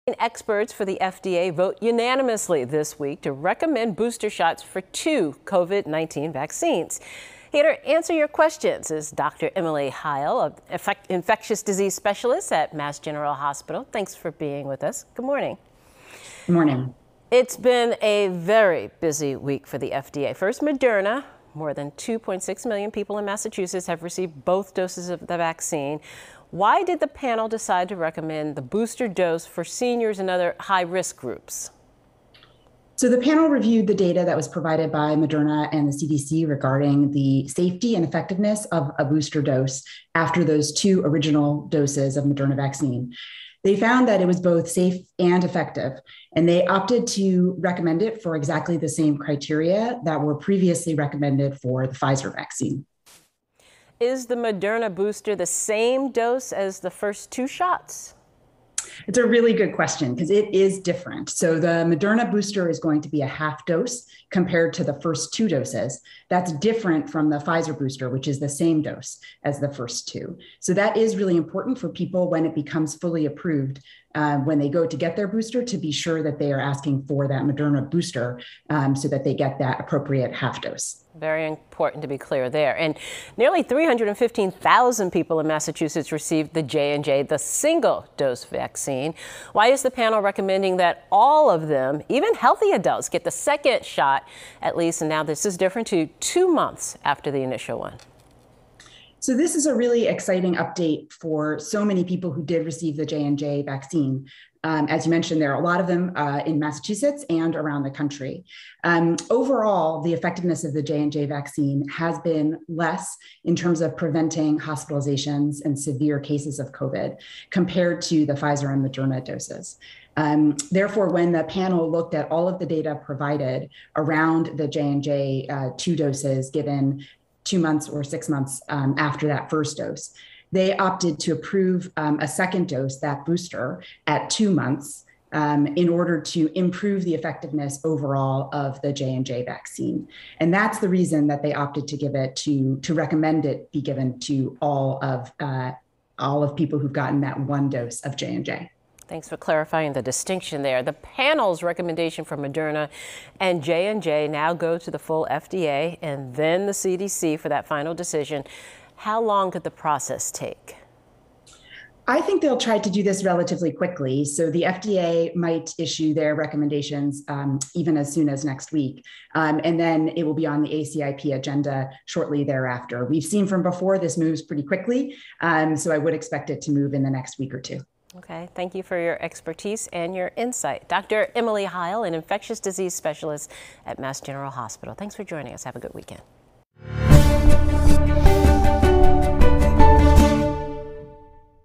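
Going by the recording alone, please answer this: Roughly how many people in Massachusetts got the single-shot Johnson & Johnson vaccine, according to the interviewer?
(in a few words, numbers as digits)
nearly 315,000.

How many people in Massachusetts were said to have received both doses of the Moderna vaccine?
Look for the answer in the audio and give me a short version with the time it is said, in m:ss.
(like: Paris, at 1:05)
More than 2.6 million, at 0:21.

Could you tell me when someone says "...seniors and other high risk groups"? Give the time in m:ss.
0:29.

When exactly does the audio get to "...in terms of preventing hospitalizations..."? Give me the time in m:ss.
1:53.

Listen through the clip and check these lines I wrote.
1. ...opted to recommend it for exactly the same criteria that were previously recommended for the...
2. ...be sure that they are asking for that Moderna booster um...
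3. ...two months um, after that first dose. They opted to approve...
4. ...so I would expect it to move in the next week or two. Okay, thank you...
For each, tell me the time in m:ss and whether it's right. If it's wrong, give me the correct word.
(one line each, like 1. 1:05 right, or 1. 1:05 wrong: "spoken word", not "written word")
1. 0:46 right
2. 1:15 right
3. 2:08 wrong: "six", not "two"
4. 2:55 right.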